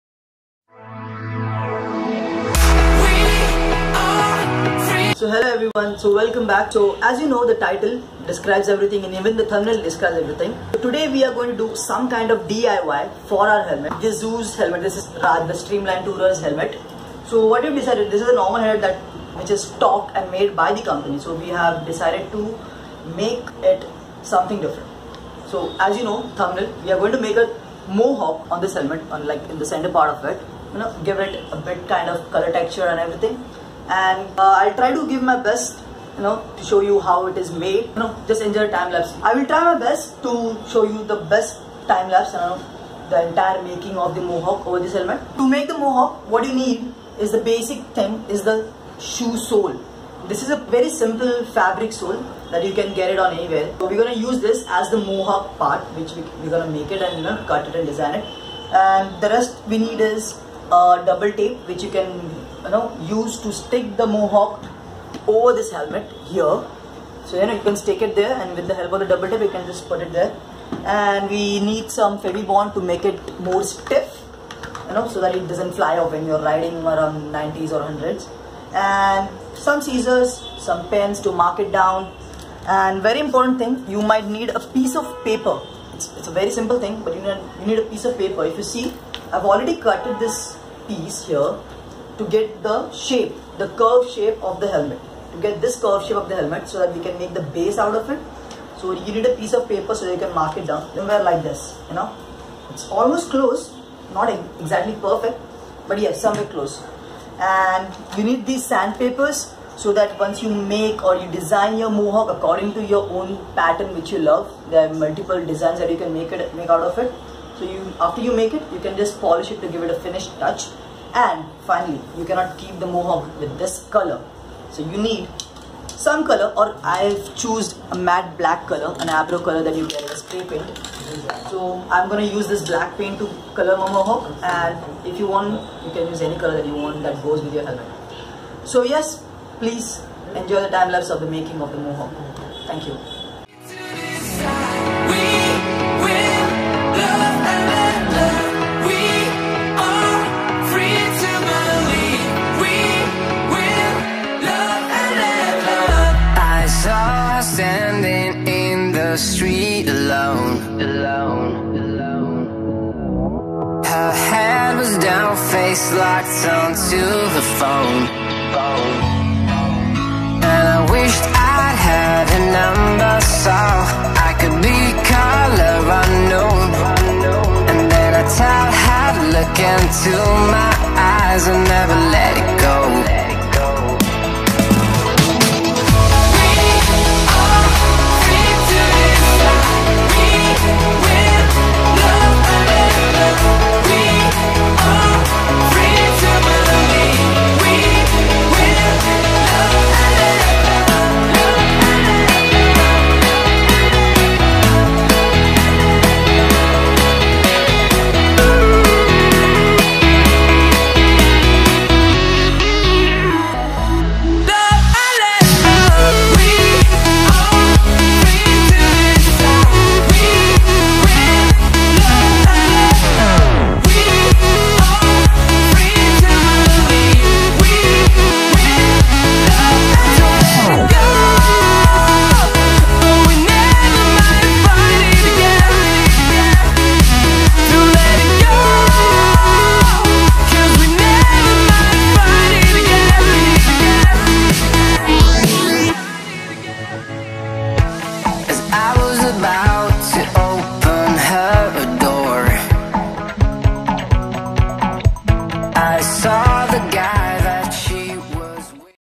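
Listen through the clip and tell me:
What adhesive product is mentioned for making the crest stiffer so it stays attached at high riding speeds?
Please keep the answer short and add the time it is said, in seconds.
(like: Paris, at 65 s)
Fevibond, at 72 s.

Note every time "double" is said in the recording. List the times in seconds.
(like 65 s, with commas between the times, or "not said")
61 s, 69 s.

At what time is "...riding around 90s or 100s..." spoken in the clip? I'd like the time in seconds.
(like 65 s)
76 s.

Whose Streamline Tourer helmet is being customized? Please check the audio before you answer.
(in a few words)
Raj.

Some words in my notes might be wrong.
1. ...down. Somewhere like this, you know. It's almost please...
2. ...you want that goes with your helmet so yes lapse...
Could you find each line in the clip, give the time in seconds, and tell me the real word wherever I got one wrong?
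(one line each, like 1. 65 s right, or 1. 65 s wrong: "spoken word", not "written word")
1. 100 s wrong: "close", not "please"
2. 136 s wrong: "please", not "lapse".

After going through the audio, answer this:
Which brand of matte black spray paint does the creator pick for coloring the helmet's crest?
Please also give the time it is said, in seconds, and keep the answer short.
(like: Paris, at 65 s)
Abro, at 129 s.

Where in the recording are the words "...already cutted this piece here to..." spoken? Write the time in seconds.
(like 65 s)
89 s.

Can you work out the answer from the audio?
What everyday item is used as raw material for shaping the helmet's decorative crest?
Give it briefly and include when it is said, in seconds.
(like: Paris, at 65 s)
shoe sole, at 49 s.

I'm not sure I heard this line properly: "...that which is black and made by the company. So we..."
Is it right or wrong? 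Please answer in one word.
wrong.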